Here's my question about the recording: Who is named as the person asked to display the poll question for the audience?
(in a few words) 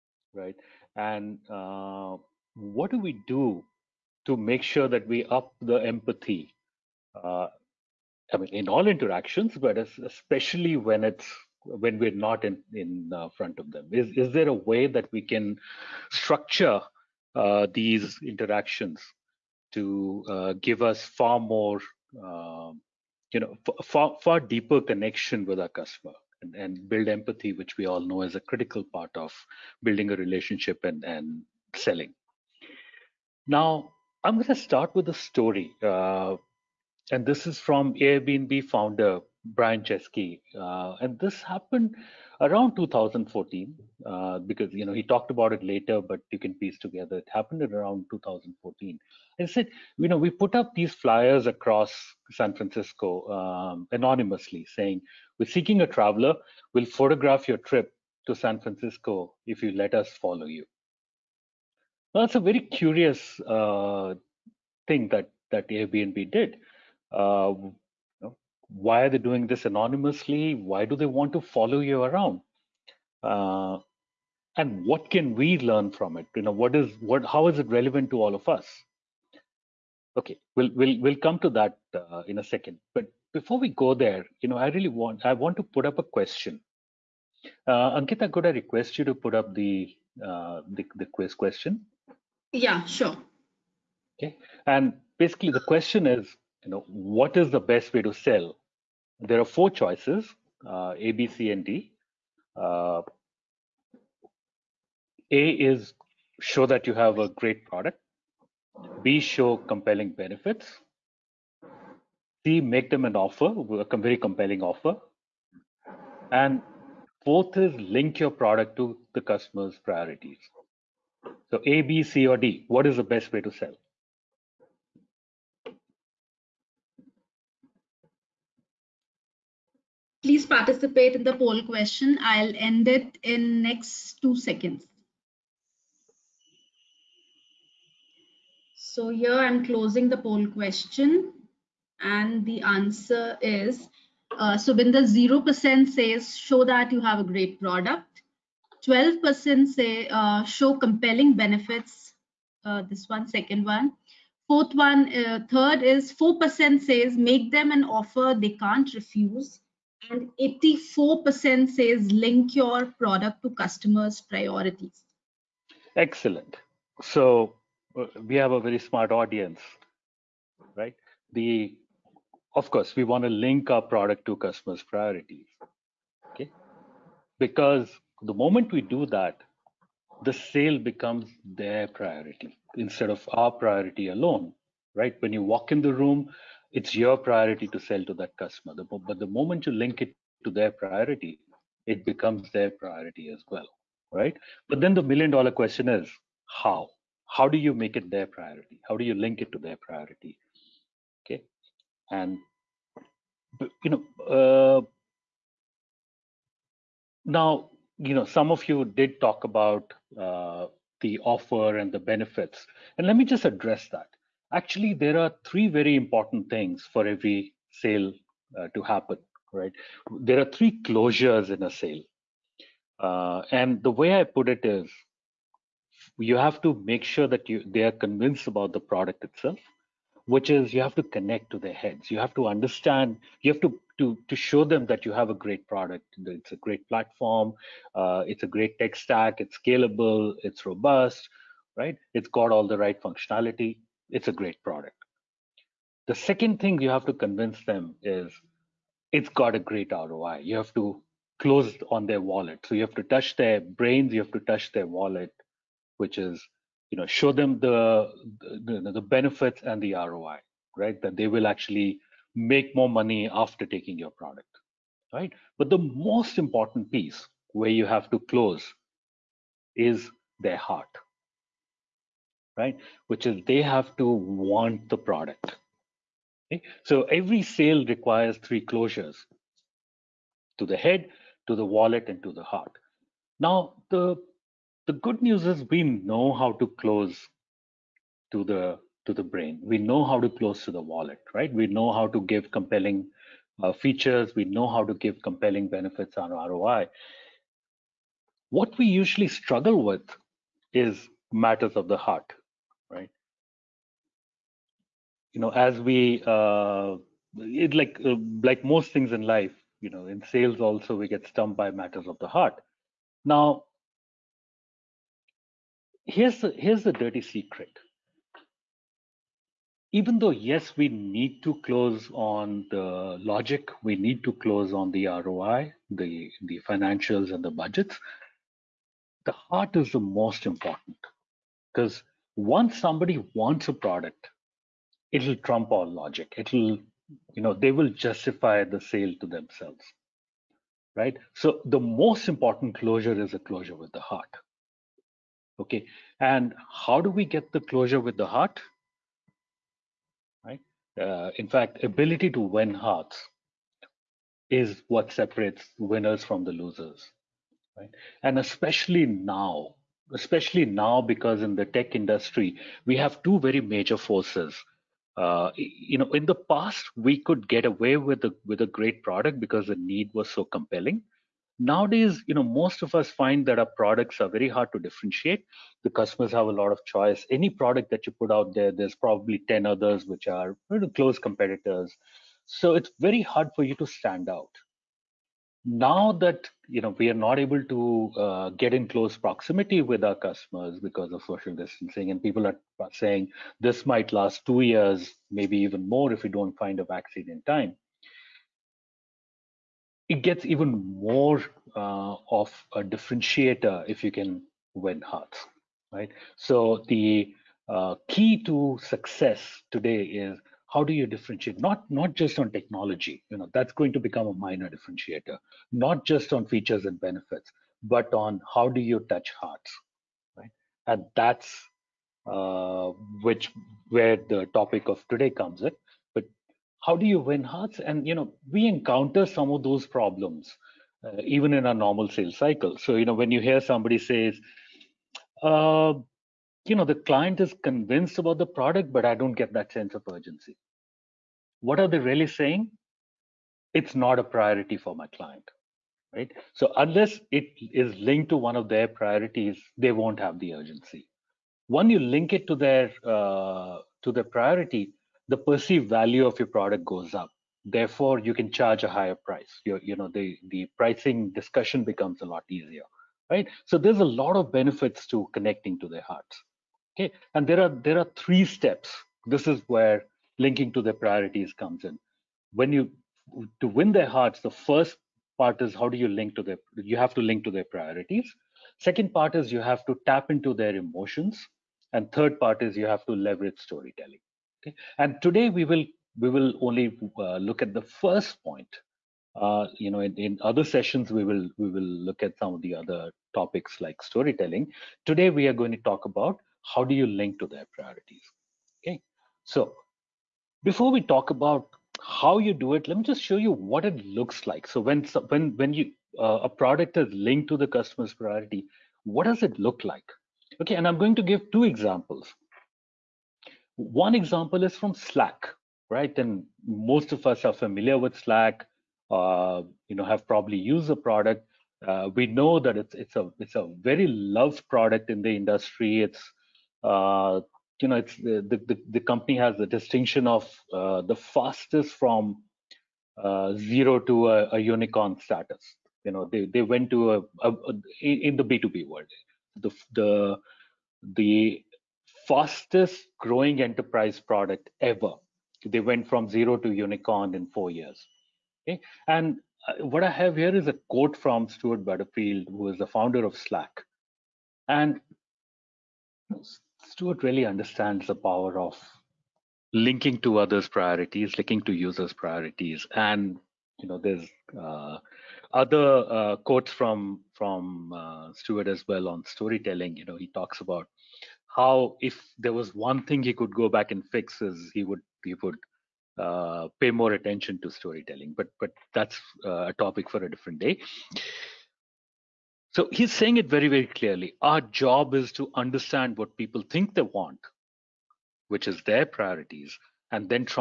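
Ankita.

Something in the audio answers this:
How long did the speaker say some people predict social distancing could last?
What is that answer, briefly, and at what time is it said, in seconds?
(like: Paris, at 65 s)
two years, at 394 s.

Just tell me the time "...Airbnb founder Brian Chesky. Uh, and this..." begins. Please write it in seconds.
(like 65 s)
37 s.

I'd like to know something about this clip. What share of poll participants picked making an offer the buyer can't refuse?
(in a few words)
4%.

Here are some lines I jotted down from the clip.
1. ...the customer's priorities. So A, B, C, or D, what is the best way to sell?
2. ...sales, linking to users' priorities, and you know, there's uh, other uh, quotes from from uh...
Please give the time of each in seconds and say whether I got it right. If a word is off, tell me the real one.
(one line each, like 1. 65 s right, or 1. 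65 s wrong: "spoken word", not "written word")
1. 119 s right
2. 560 s wrong: "priorities", not "sales".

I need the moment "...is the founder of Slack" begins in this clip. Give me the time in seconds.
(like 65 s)
552 s.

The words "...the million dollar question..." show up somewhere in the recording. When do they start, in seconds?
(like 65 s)
194 s.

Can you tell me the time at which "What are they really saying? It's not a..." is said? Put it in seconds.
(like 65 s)
441 s.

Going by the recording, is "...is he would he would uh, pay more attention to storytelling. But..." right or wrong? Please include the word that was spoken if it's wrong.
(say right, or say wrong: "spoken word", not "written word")
right.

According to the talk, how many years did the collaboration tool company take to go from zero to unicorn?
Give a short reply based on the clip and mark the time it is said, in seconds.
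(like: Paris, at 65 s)
4 years, at 547 s.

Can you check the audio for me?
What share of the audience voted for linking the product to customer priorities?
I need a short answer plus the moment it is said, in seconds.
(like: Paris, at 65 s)
84%, at 160 s.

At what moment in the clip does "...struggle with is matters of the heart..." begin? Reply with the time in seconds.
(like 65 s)
299 s.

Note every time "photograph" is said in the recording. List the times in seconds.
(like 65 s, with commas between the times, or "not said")
56 s.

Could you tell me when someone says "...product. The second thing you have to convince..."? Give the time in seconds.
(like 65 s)
244 s.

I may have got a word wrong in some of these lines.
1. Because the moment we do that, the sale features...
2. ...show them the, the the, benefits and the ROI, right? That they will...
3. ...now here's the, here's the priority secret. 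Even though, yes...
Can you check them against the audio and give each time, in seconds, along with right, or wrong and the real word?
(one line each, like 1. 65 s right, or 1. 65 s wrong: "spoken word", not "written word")
1. 177 s wrong: "becomes", not "features"
2. 257 s right
3. 313 s wrong: "dirty", not "priority".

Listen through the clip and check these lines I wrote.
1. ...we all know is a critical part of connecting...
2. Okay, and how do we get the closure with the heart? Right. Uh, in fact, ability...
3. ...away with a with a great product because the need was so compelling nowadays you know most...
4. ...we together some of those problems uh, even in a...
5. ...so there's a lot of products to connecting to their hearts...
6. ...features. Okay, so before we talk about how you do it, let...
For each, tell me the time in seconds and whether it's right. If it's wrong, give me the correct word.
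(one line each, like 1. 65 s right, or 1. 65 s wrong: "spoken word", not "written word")
1. 27 s wrong: "building", not "connecting"
2. 345 s right
3. 367 s right
4. 428 s wrong: "encounter", not "together"
5. 463 s wrong: "benefits", not "products"
6. 497 s wrong: "priorities", not "features".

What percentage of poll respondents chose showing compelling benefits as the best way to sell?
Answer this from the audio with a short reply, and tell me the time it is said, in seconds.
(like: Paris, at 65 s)
12%, at 148 s.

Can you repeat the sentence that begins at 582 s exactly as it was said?
So he's saying it very very clearly.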